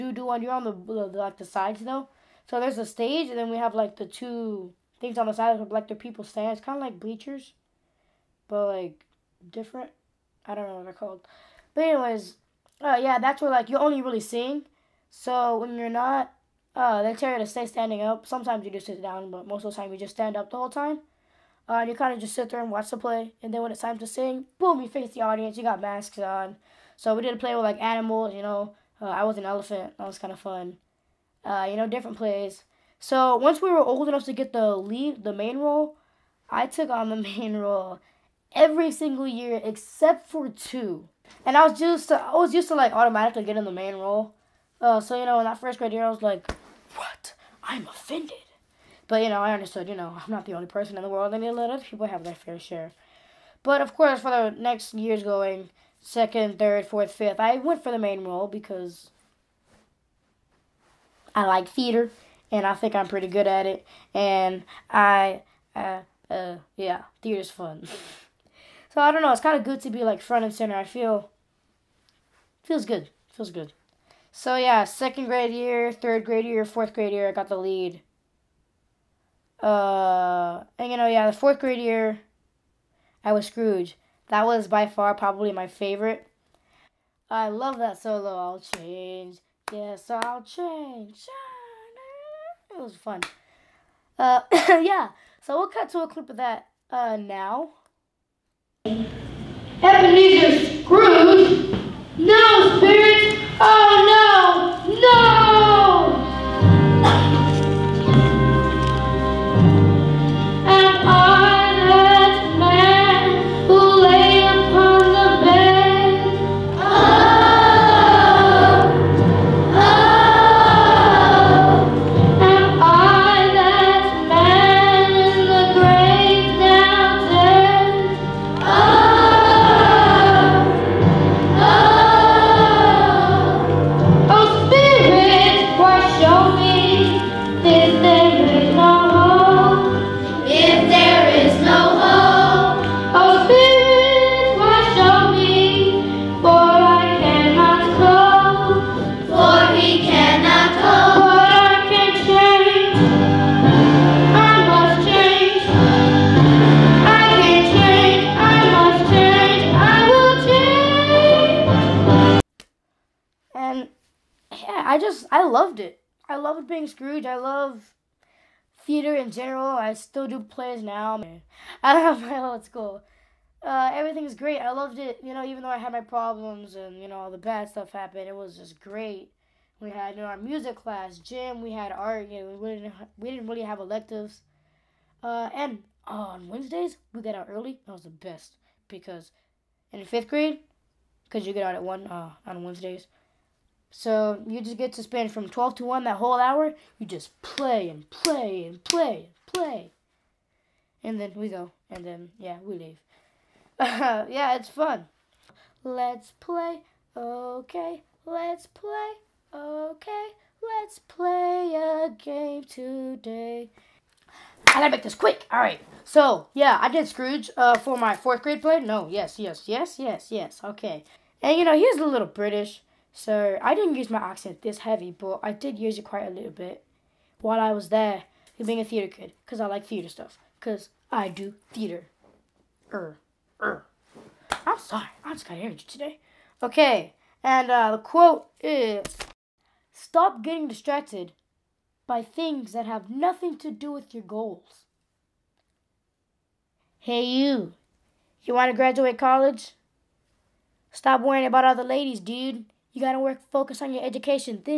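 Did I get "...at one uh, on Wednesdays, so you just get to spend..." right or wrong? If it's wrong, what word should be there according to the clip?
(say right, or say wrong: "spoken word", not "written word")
right.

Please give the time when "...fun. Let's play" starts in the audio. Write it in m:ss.
3:24.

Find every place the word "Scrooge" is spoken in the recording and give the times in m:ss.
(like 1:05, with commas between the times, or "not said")
1:23, 2:46, 3:37.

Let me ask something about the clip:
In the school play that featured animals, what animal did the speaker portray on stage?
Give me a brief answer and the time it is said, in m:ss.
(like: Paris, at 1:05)
Elephant, at 0:29.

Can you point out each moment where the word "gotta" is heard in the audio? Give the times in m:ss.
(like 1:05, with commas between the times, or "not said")
3:34, 4:13.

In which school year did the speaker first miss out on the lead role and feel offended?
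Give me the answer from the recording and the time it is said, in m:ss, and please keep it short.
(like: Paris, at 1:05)
First grade, at 0:45.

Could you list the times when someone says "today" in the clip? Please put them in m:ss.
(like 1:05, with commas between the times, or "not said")
3:32, 3:55.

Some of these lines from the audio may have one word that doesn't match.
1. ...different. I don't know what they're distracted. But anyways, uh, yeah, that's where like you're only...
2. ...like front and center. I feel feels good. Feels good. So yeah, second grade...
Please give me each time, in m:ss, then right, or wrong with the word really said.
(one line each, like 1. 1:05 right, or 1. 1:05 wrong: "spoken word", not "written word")
1. 0:09 wrong: "called", not "distracted"
2. 1:10 right.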